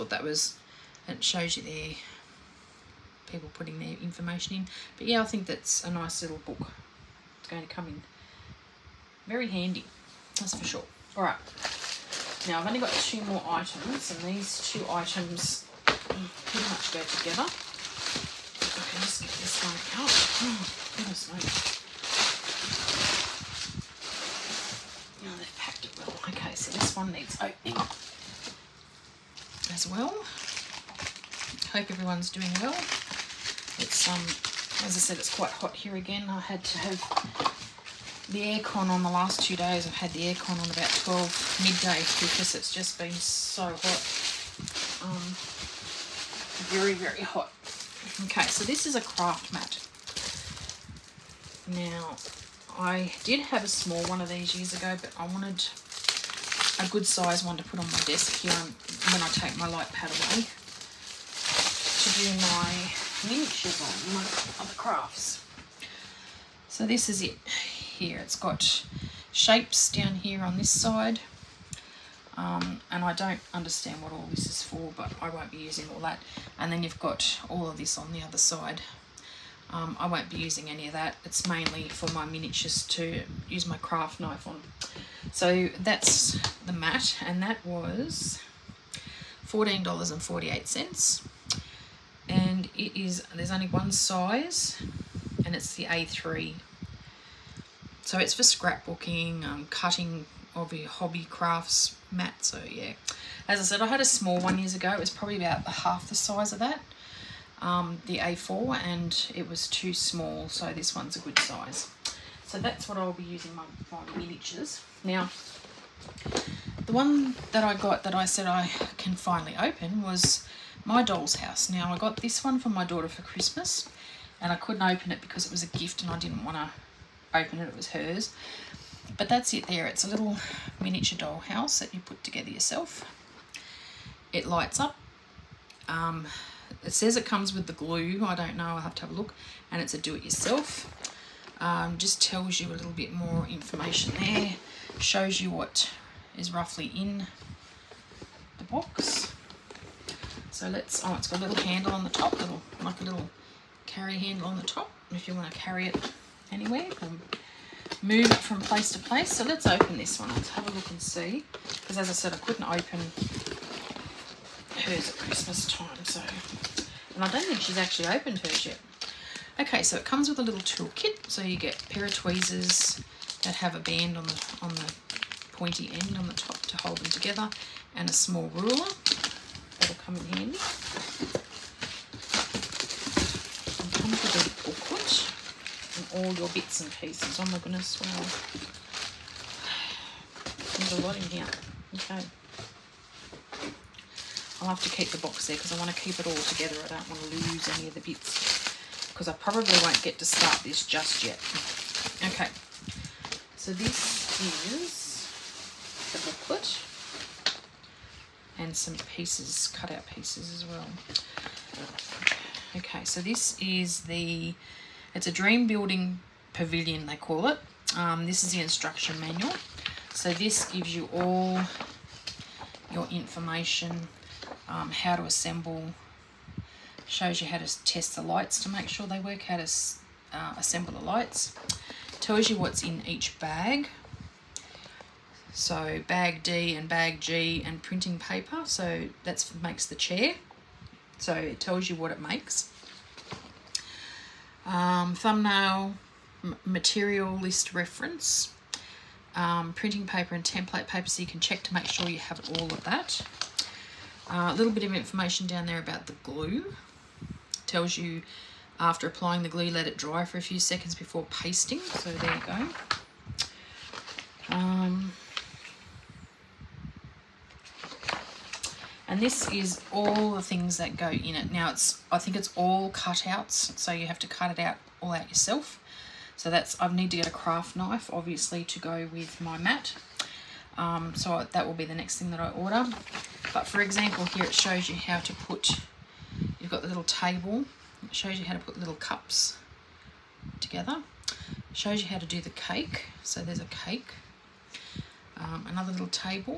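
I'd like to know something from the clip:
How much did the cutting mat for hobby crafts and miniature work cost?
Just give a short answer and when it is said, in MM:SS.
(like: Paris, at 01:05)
$14.48, at 01:29.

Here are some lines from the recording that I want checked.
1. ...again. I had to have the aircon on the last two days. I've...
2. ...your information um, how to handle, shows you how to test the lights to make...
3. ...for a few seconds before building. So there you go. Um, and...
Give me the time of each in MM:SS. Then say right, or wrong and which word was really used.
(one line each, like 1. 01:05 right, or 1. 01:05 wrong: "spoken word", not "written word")
1. 00:35 right
2. 03:42 wrong: "assemble", not "handle"
3. 04:20 wrong: "pasting", not "building".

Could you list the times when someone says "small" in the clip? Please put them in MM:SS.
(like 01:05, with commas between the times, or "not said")
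00:53, 01:44, 01:49, 02:58.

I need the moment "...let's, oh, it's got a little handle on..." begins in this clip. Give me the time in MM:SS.
02:30.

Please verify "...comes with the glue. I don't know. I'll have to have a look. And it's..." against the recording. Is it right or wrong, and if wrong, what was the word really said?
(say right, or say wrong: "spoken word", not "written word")
right.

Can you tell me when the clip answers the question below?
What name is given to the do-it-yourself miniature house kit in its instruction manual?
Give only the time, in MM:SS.
03:35.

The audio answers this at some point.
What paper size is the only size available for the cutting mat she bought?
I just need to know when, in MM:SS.
01:35.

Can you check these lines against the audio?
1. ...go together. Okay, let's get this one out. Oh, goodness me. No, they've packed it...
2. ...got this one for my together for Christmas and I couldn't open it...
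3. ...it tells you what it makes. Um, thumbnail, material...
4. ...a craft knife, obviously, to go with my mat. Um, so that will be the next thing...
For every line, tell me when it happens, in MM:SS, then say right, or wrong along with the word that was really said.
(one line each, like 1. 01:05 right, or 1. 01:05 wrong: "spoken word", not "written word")
1. 00:16 right
2. 02:01 wrong: "daughter", not "together"
3. 04:01 right
4. 04:37 right.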